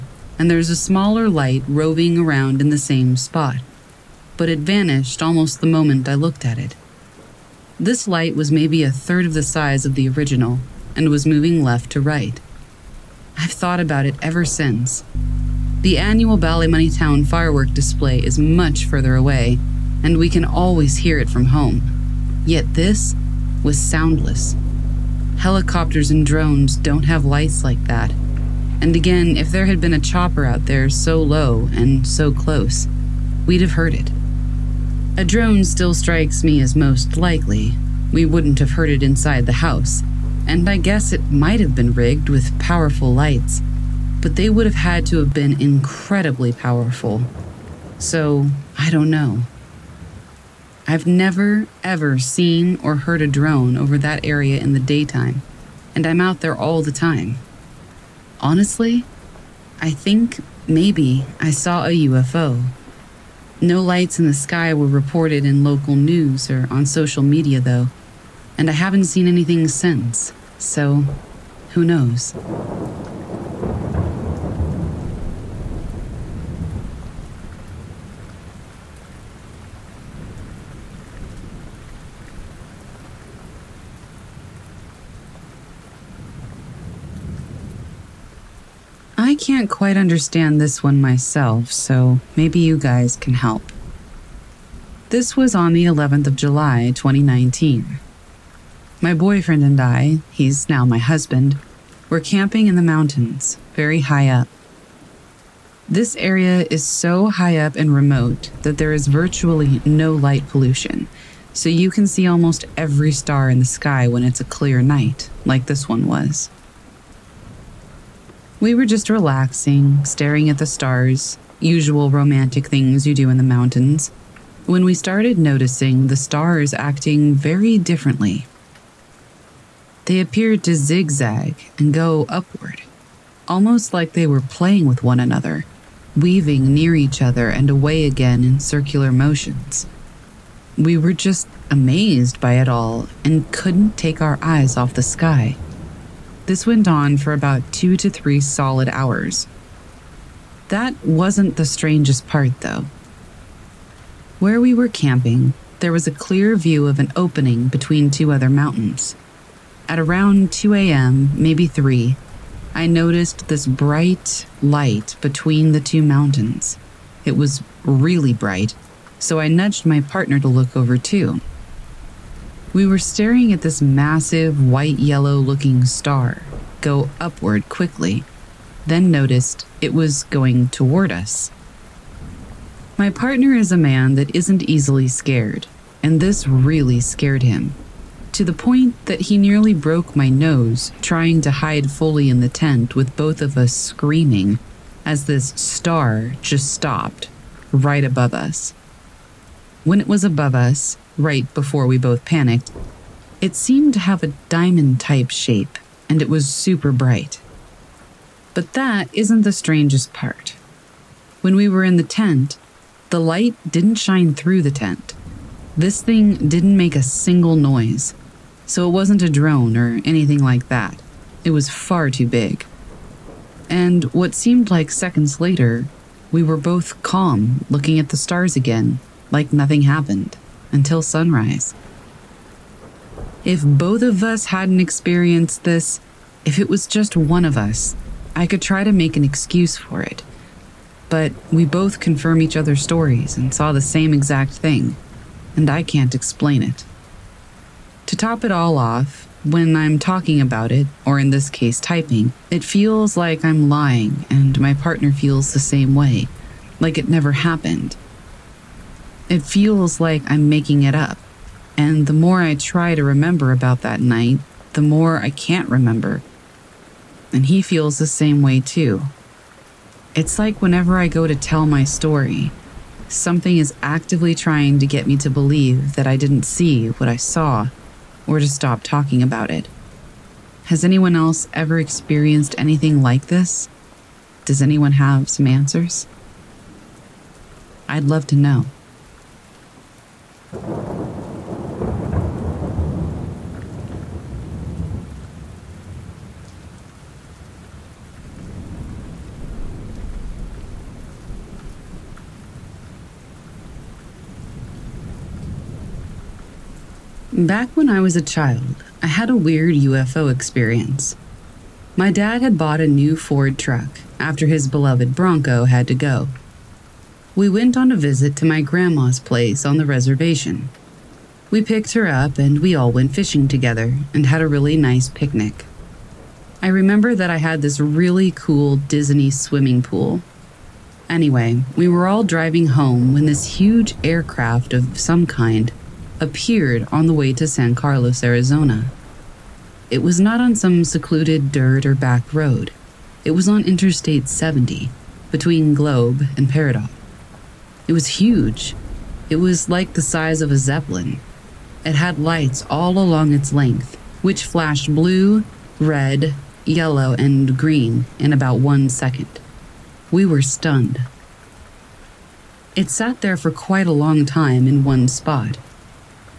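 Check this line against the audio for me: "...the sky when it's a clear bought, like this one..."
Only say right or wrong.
wrong.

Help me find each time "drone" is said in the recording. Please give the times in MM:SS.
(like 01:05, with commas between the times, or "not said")
00:26, 00:35, 00:53, 03:39.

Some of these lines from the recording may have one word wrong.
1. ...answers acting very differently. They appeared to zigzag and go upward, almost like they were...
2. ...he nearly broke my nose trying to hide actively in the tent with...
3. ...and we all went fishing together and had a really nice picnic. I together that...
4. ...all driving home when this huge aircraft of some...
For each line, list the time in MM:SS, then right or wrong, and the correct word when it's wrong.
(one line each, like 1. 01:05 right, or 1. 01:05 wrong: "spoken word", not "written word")
1. 02:06 wrong: "stars", not "answers"
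2. 03:09 wrong: "fully", not "actively"
3. 05:22 wrong: "remember", not "together"
4. 05:32 right.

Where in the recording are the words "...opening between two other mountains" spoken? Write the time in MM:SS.
02:37.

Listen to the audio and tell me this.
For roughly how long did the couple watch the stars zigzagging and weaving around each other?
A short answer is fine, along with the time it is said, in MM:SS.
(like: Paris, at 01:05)
2 to 3 hours, at 02:27.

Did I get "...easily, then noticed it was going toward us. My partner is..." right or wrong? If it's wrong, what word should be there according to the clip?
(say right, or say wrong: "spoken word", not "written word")
wrong: "quickly", not "easily".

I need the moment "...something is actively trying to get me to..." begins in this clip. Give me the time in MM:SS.
04:33.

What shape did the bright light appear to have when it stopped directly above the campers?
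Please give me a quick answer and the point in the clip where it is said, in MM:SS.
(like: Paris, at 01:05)
Diamond, at 03:24.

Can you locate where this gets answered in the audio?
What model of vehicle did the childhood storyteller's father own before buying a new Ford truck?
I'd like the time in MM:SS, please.
05:15.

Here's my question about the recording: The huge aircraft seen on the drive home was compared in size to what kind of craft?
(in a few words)
A zeppelin.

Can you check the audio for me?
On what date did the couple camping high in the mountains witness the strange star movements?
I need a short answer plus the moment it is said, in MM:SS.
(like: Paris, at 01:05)
11 July 2019, at 01:35.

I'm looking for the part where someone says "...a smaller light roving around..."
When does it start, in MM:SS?
00:00.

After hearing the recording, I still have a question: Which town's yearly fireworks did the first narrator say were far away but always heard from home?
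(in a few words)
Ballymoney.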